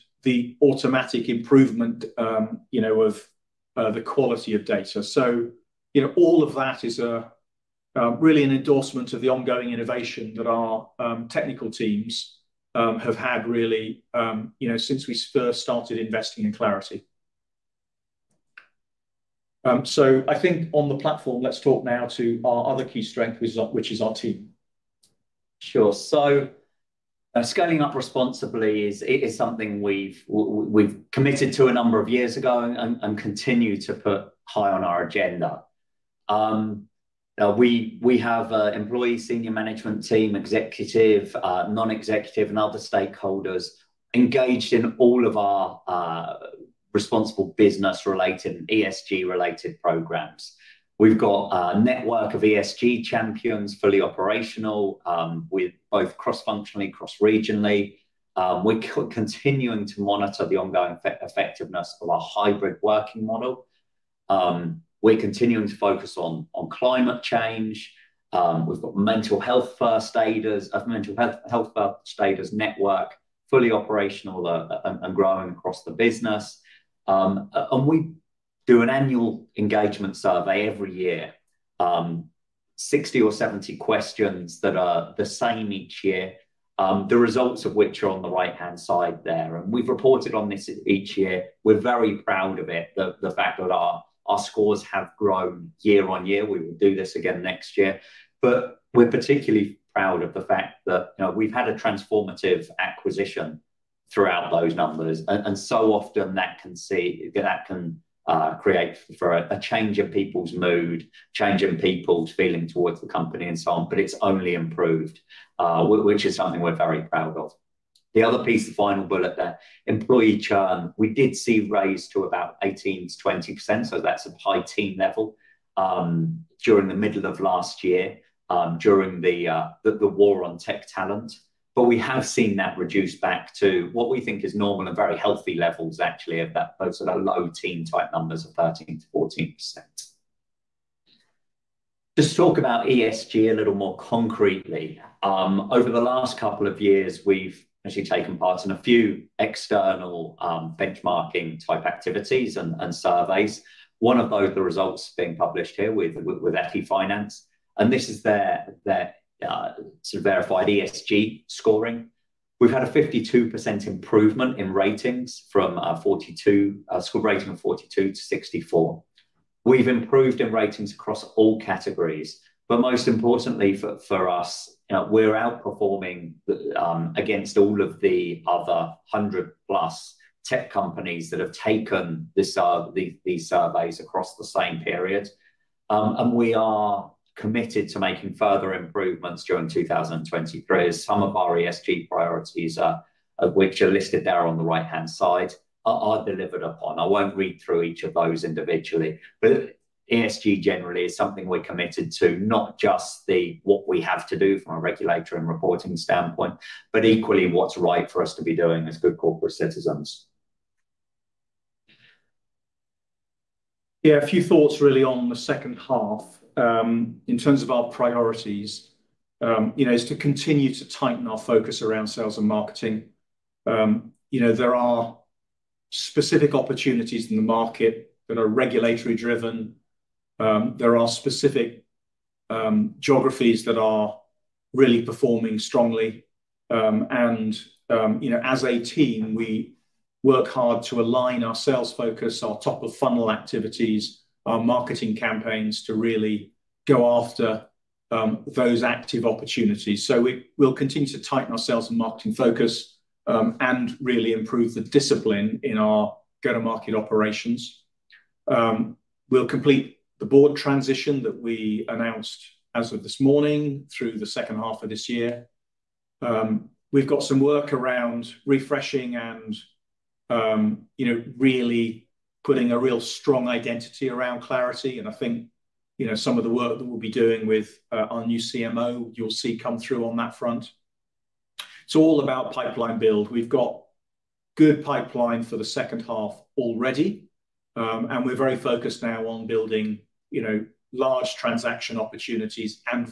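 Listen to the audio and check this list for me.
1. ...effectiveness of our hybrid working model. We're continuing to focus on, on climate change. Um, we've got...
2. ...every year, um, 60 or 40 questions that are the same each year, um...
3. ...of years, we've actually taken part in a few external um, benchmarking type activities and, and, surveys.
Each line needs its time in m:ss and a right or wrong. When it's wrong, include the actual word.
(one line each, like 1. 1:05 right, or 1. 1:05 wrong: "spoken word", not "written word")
1. 1:01 right
2. 1:20 wrong: "70", not "40"
3. 2:26 right.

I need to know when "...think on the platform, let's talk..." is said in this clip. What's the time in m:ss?
0:20.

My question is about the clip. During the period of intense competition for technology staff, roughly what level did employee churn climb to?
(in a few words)
18 to 20 percent.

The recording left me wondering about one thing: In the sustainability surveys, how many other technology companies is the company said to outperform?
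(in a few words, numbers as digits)
100 plus.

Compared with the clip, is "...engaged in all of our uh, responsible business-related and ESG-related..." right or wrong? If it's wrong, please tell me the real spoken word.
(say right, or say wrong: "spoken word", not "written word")
right.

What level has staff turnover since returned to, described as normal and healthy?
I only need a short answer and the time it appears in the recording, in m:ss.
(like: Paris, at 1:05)
13 to 14 percent, at 2:18.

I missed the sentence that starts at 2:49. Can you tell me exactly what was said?
We've improved in ratings across all categories.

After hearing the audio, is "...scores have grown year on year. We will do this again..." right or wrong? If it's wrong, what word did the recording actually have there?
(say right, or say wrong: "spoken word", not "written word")
right.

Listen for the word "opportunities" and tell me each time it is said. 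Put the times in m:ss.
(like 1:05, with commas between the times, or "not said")
3:46, 4:09, 4:51.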